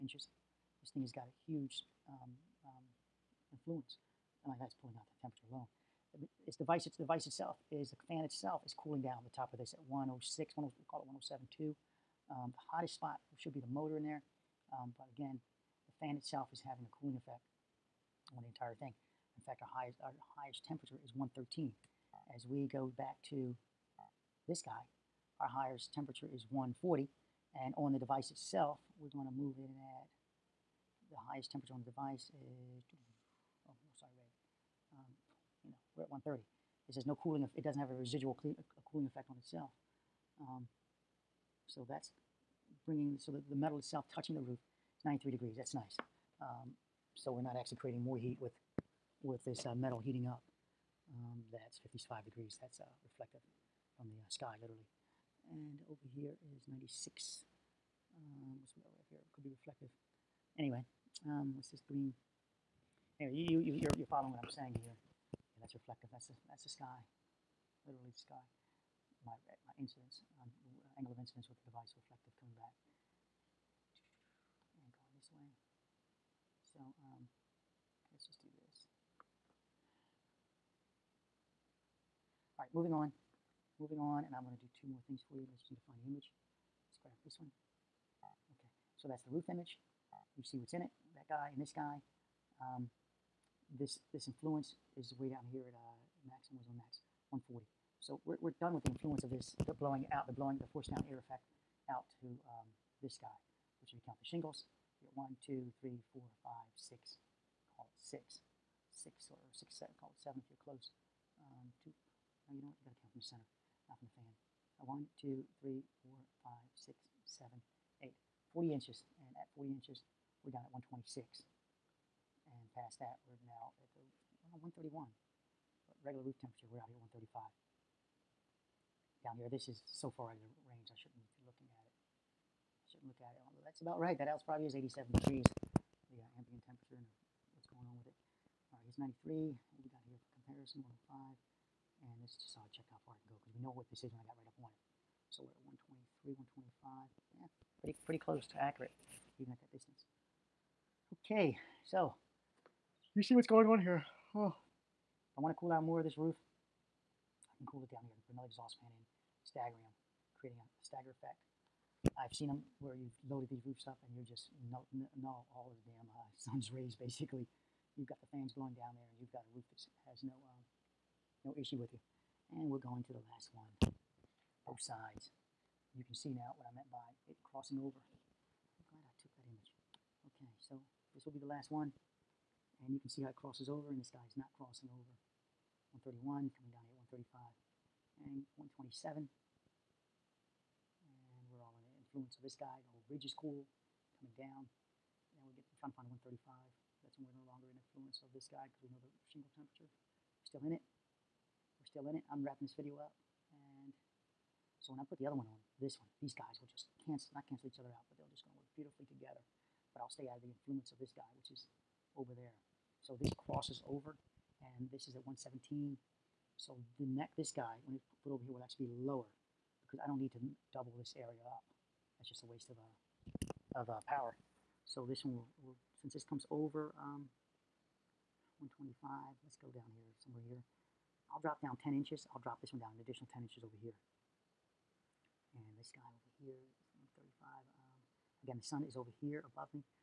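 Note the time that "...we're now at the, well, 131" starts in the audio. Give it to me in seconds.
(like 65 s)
123 s.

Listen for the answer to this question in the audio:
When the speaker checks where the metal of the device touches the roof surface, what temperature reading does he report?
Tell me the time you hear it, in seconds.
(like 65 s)
45 s.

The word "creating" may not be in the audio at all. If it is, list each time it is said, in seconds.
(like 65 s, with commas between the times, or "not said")
47 s, 160 s.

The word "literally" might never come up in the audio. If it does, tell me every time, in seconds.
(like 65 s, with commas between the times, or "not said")
54 s, 67 s.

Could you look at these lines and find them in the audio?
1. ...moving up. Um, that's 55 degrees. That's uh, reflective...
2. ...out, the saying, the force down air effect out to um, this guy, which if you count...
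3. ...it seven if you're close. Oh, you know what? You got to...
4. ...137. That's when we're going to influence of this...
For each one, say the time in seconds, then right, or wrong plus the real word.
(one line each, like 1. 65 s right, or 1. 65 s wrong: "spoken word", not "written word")
1. 50 s wrong: "heating", not "moving"
2. 100 s wrong: "blowing", not "saying"
3. 110 s right
4. 196 s wrong: "135", not "137".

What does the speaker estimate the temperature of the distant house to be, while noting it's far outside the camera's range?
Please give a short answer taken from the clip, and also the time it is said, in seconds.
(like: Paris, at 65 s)
87 degrees, at 134 s.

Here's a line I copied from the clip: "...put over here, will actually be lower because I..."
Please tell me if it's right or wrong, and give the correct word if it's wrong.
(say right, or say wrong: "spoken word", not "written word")
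right.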